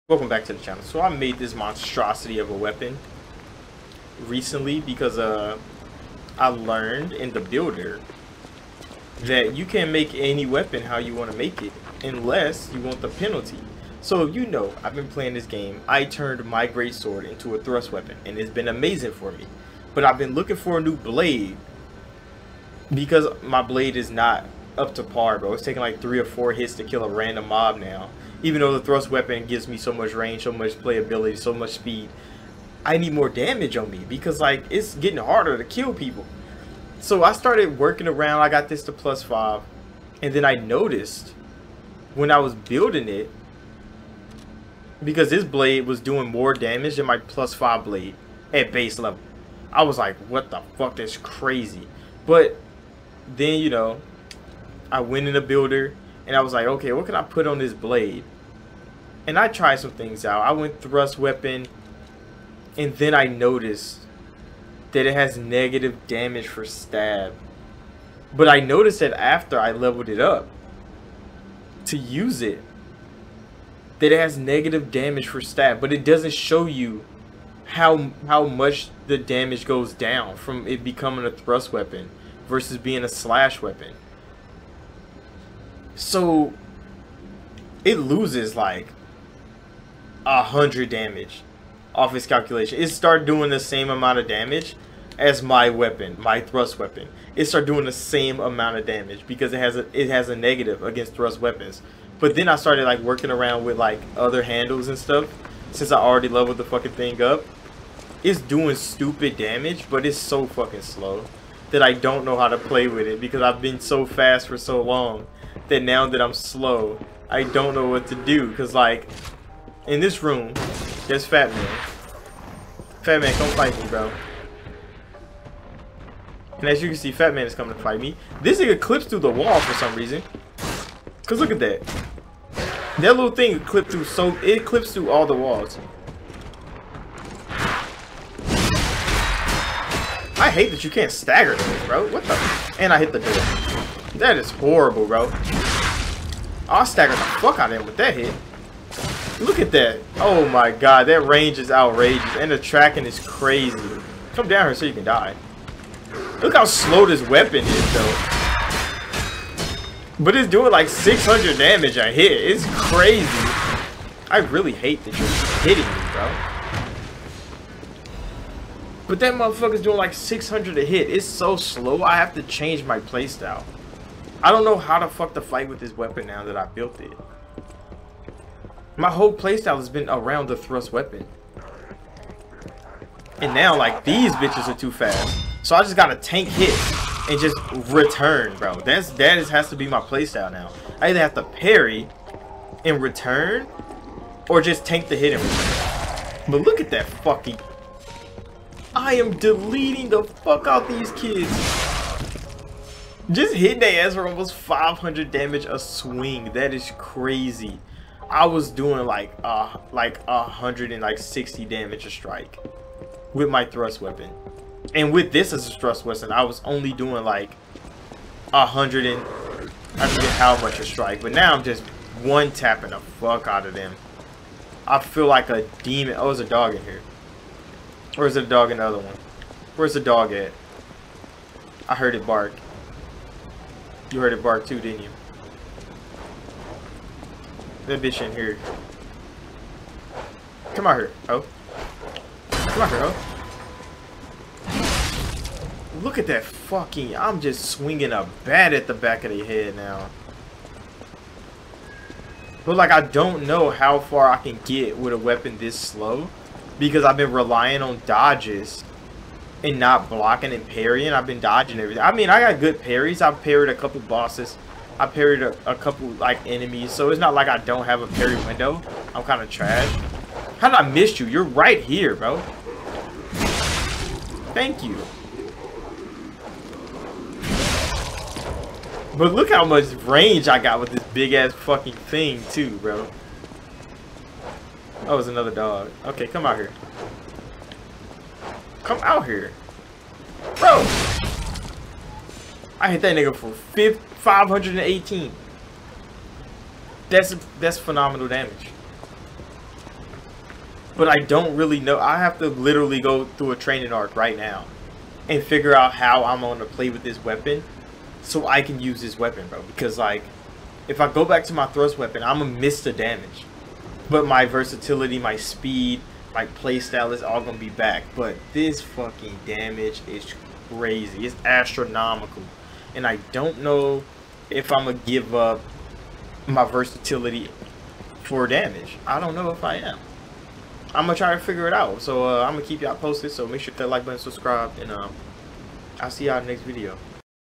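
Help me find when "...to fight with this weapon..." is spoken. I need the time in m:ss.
2:55.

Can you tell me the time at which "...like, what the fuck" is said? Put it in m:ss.
0:49.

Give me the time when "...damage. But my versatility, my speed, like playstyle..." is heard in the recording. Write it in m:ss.
5:12.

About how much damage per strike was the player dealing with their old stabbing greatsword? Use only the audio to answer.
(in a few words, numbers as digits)
160.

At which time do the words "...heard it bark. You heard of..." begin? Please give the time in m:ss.
3:51.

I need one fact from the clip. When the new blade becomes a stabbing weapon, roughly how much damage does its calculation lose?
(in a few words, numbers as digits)
100.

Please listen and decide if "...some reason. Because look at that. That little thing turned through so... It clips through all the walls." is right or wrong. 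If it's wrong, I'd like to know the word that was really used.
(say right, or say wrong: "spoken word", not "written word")
wrong: "clipped", not "turned".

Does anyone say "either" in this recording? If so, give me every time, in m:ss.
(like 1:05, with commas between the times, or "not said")
3:11.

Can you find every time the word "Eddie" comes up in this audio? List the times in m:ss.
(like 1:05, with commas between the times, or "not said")
not said.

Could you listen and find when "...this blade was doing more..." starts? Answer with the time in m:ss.
0:45.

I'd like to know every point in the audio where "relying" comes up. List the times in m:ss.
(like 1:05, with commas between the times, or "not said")
4:17.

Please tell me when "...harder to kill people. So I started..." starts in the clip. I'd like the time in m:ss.
0:35.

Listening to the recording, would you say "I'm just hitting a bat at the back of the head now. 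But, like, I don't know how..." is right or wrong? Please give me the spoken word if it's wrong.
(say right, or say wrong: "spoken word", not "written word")
wrong: "swinging", not "hitting".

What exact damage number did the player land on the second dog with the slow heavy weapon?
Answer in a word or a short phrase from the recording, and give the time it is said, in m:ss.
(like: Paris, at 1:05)
518, at 4:53.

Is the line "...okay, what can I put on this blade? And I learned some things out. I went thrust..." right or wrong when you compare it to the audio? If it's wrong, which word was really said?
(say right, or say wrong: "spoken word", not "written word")
wrong: "tried", not "learned".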